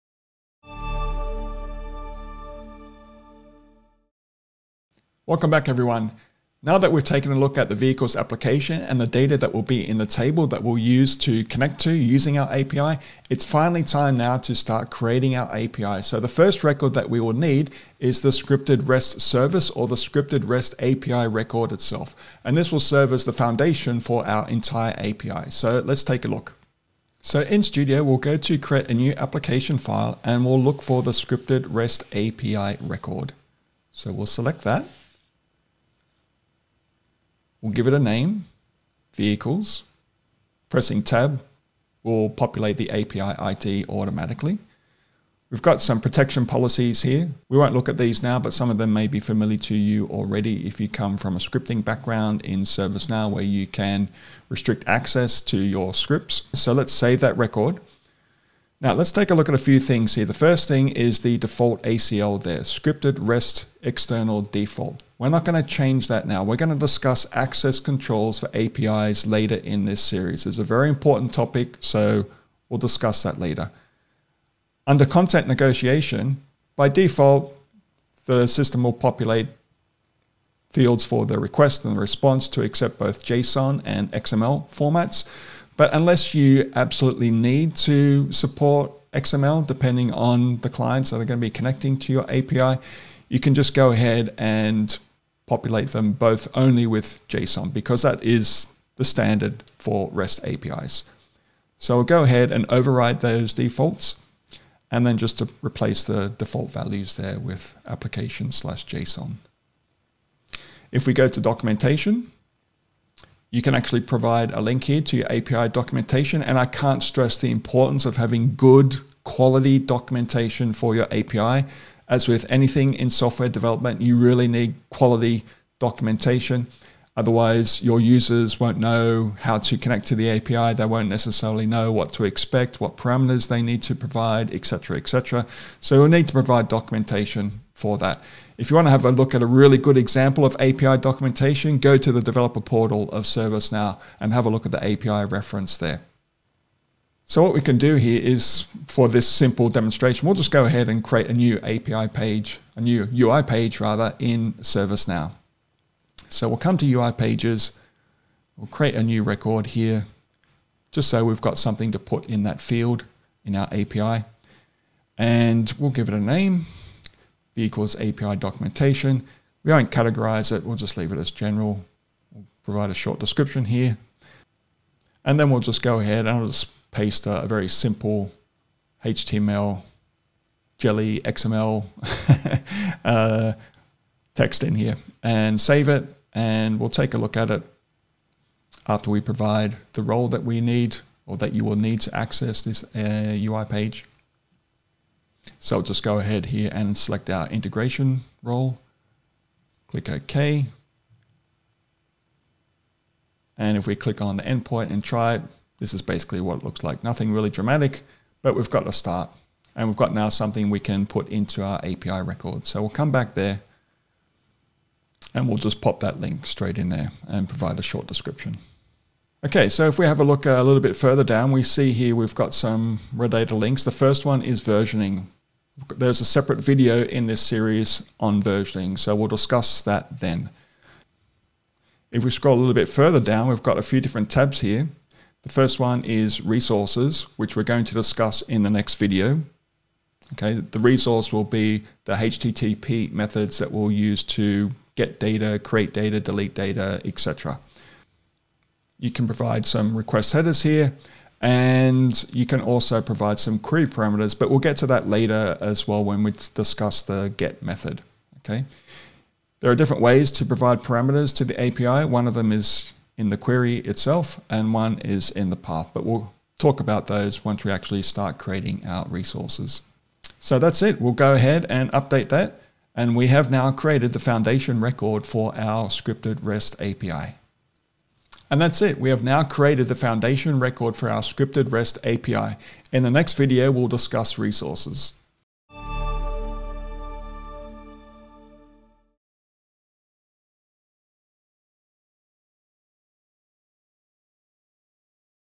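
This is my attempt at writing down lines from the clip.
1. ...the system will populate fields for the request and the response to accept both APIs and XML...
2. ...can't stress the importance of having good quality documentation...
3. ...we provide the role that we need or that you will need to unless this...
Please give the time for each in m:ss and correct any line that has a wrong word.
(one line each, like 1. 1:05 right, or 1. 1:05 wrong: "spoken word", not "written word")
1. 1:18 wrong: "JSON", not "APIs"
2. 1:56 right
3. 3:09 wrong: "access", not "unless".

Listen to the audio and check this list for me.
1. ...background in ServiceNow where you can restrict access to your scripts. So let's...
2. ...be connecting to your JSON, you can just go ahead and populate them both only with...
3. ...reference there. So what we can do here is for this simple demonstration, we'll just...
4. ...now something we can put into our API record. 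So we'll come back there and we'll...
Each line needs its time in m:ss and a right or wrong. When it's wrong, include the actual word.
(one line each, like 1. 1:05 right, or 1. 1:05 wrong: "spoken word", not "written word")
1. 0:51 right
2. 1:31 wrong: "API", not "JSON"
3. 2:25 right
4. 3:30 right.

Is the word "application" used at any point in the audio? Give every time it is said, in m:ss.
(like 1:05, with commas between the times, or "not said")
0:08, 0:29, 1:47.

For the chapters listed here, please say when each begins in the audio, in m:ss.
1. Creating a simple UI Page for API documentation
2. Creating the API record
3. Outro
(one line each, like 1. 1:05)
1. 2:27
2. 0:27
3. 4:38.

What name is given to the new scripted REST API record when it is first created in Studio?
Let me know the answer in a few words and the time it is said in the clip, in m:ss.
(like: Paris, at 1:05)
vehicles, at 0:39.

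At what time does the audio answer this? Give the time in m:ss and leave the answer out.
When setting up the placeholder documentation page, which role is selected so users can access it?
3:17.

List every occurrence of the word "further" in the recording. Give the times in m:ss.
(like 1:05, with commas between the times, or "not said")
3:40, 3:52.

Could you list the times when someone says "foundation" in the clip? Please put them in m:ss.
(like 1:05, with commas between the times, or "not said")
0:23, 4:34, 4:39.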